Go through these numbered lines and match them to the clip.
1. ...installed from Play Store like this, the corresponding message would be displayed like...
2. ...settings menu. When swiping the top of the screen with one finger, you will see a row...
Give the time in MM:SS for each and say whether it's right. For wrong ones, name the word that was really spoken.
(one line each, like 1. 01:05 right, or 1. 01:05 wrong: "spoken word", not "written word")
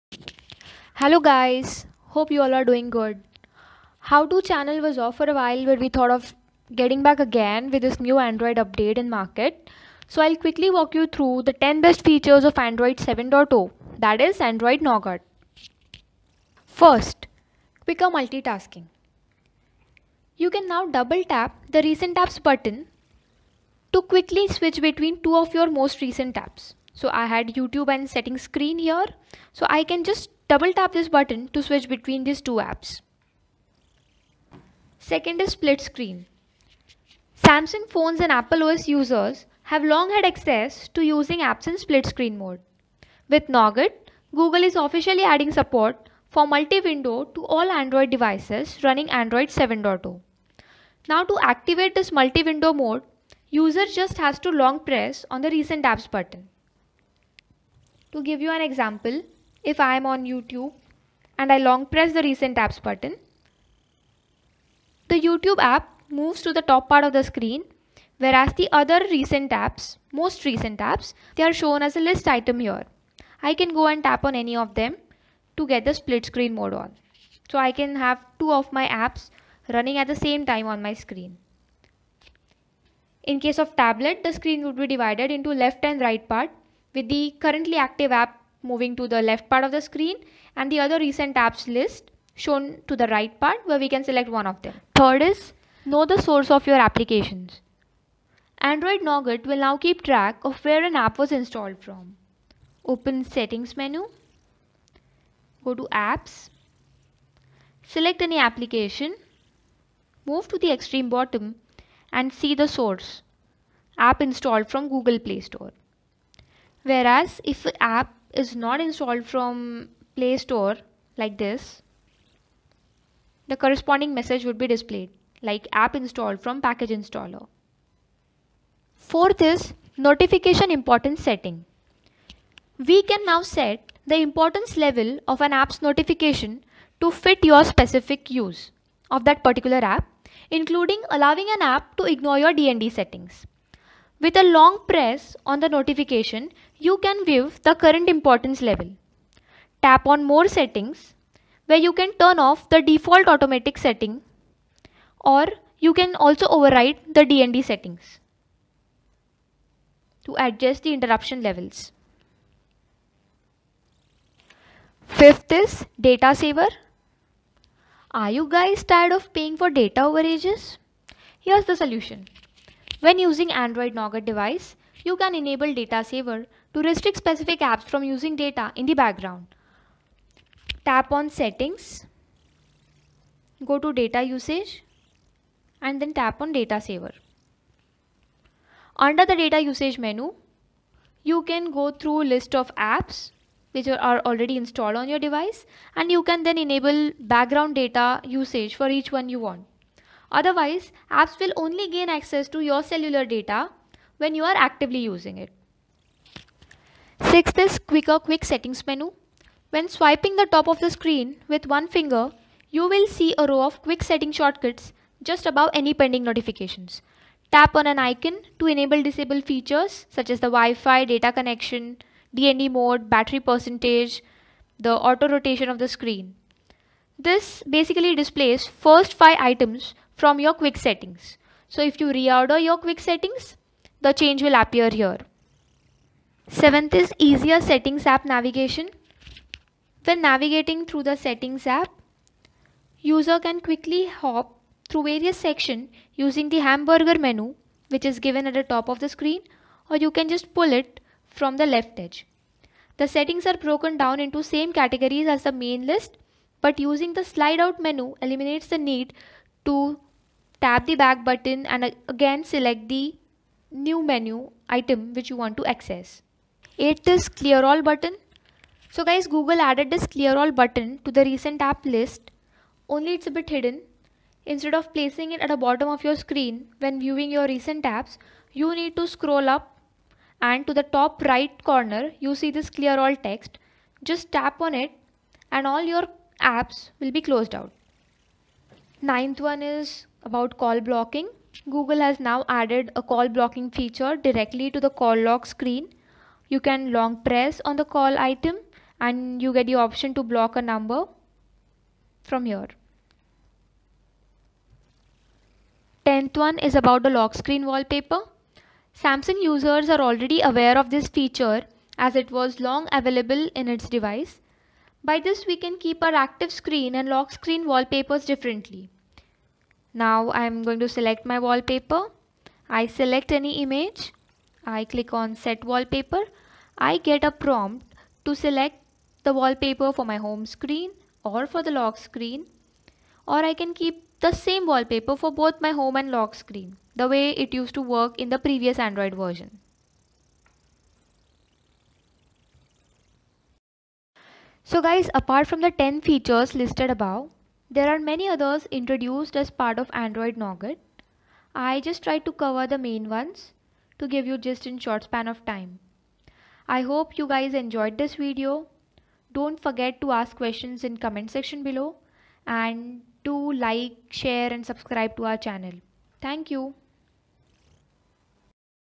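1. 01:58 right
2. 03:28 right.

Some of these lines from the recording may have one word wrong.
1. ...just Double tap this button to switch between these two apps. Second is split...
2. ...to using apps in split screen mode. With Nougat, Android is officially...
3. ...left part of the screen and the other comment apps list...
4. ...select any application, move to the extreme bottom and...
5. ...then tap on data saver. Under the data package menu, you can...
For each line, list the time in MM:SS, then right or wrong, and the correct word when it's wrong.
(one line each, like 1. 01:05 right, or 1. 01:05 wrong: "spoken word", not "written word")
1. 00:30 right
2. 00:40 wrong: "Google", not "Android"
3. 01:29 wrong: "recent", not "comment"
4. 01:47 right
5. 03:06 wrong: "usage", not "package".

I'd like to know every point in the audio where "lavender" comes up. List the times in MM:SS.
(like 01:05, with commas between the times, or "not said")
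not said.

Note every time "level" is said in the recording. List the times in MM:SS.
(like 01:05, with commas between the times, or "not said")
02:14, 02:28, 02:41.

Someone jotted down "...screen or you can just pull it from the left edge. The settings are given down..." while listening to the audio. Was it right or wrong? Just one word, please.
wrong.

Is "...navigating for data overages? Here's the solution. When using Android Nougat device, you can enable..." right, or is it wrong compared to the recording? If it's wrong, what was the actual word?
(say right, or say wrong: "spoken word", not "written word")
wrong: "paying", not "navigating".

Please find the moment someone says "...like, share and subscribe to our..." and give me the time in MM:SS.
06:03.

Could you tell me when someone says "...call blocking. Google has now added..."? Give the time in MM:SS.
04:50.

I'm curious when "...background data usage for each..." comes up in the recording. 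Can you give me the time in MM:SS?
03:17.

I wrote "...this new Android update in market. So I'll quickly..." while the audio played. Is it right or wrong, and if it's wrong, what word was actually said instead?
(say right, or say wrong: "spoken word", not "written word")
right.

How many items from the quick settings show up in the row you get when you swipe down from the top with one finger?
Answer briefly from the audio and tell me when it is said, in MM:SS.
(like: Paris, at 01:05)
5, at 03:49.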